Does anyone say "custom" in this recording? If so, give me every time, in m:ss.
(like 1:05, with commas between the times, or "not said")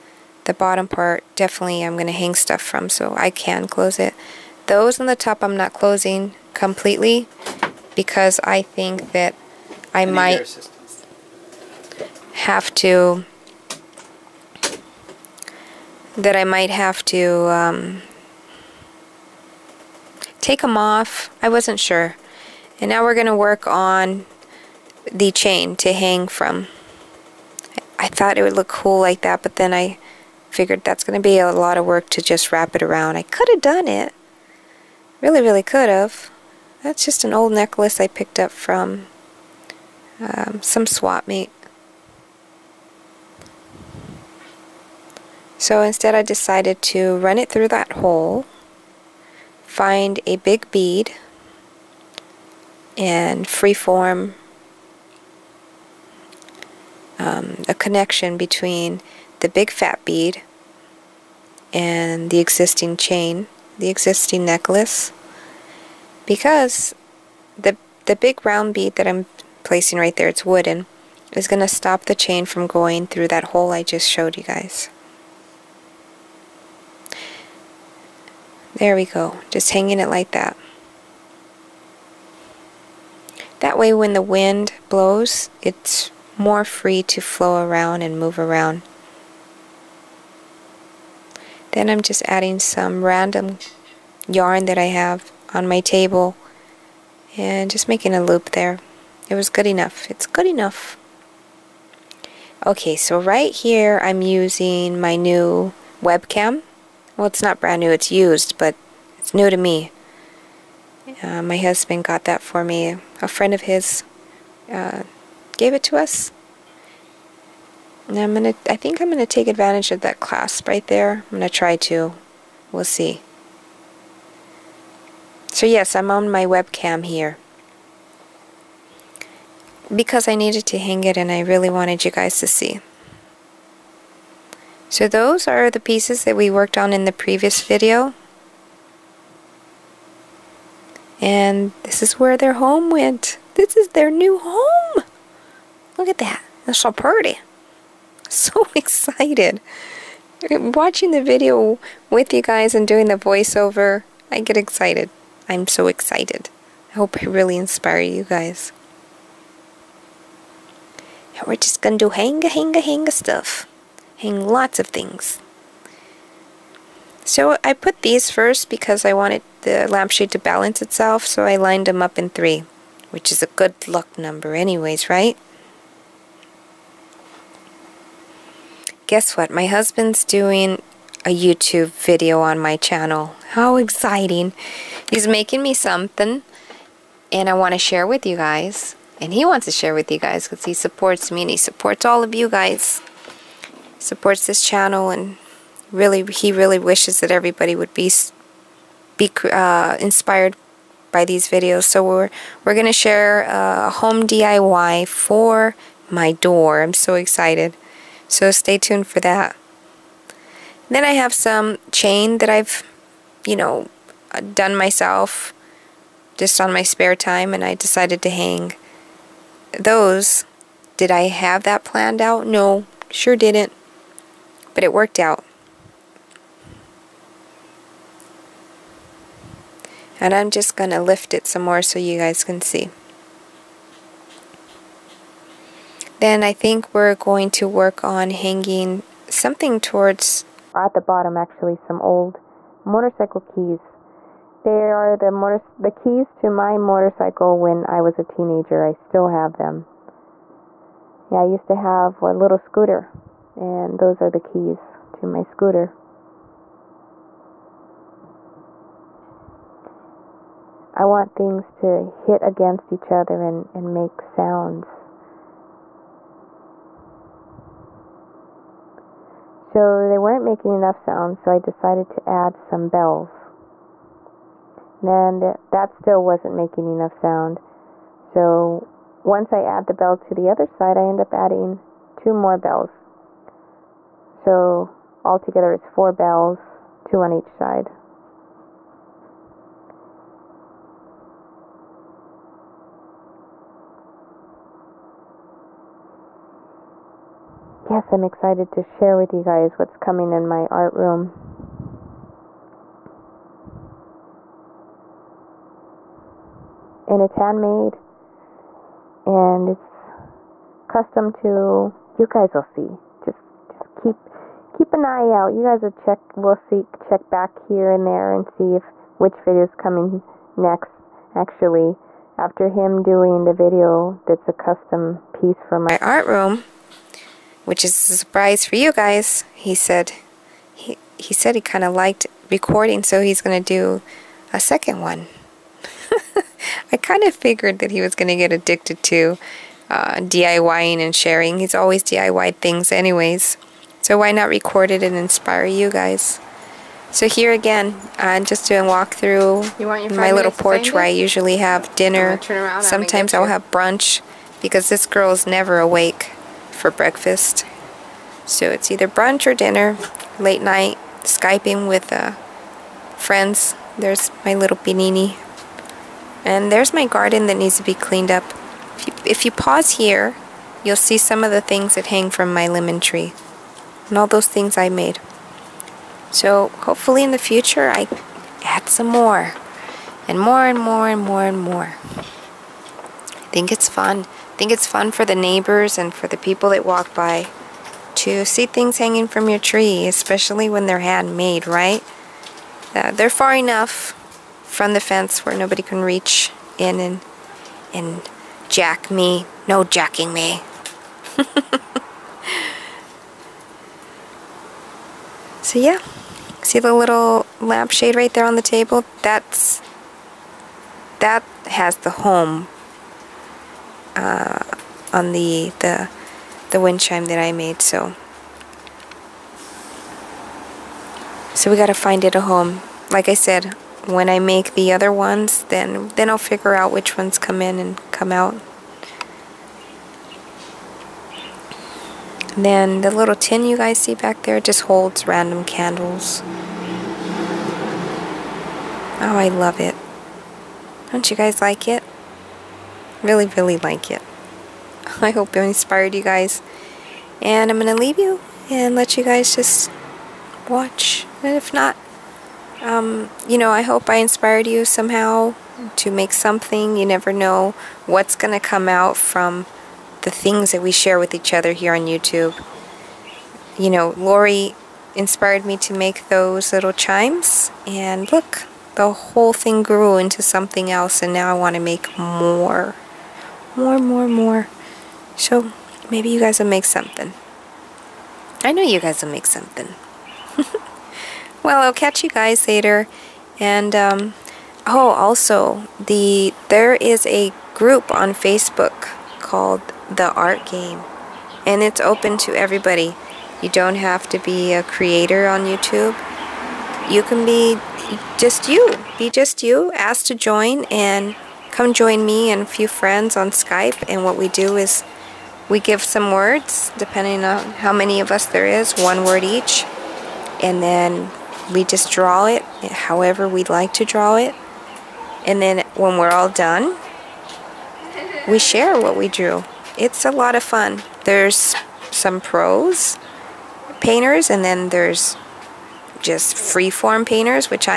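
5:10, 5:24.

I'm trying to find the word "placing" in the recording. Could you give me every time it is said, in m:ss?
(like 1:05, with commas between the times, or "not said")
1:09.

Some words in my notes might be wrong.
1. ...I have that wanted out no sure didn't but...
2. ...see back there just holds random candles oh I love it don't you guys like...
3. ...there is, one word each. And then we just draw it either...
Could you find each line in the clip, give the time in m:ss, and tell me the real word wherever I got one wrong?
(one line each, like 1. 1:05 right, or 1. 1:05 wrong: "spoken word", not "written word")
1. 3:41 wrong: "planned", not "wanted"
2. 7:13 right
3. 8:28 wrong: "however", not "either".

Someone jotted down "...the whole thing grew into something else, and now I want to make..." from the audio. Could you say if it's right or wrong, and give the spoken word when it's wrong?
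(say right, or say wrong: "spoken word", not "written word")
right.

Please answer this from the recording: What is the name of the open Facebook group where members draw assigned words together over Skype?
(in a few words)
The Art Game.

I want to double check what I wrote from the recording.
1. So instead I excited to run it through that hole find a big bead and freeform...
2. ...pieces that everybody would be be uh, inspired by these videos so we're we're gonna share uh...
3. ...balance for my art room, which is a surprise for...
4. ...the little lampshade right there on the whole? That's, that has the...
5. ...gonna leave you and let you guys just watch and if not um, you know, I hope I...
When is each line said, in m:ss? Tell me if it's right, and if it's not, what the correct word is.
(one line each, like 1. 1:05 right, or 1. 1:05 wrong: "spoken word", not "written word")
1. 0:45 wrong: "decided", not "excited"
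2. 3:16 wrong: "wishes", not "pieces"
3. 5:25 wrong: "piece", not "balance"
4. 6:46 wrong: "table", not "whole"
5. 7:27 right.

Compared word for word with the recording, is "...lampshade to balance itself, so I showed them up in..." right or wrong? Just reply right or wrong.
wrong.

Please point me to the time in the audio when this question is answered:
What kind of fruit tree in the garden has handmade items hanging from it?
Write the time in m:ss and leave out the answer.
6:12.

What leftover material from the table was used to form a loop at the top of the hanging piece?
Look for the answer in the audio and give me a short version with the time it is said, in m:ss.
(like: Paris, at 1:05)
Yarn, at 1:34.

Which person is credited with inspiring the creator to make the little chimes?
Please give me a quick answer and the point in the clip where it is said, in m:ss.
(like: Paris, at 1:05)
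Lori, at 7:44.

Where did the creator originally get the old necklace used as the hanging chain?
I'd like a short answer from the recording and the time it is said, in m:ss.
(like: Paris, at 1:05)
Swap meet, at 0:40.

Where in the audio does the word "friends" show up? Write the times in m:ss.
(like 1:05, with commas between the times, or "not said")
1:53, 6:03, 8:22.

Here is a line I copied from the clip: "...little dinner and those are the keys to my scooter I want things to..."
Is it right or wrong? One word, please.
wrong.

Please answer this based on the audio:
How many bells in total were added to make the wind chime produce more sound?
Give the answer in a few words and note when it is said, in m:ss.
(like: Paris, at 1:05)
4, at 4:45.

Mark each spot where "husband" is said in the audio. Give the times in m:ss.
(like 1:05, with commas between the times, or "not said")
1:51, 2:59.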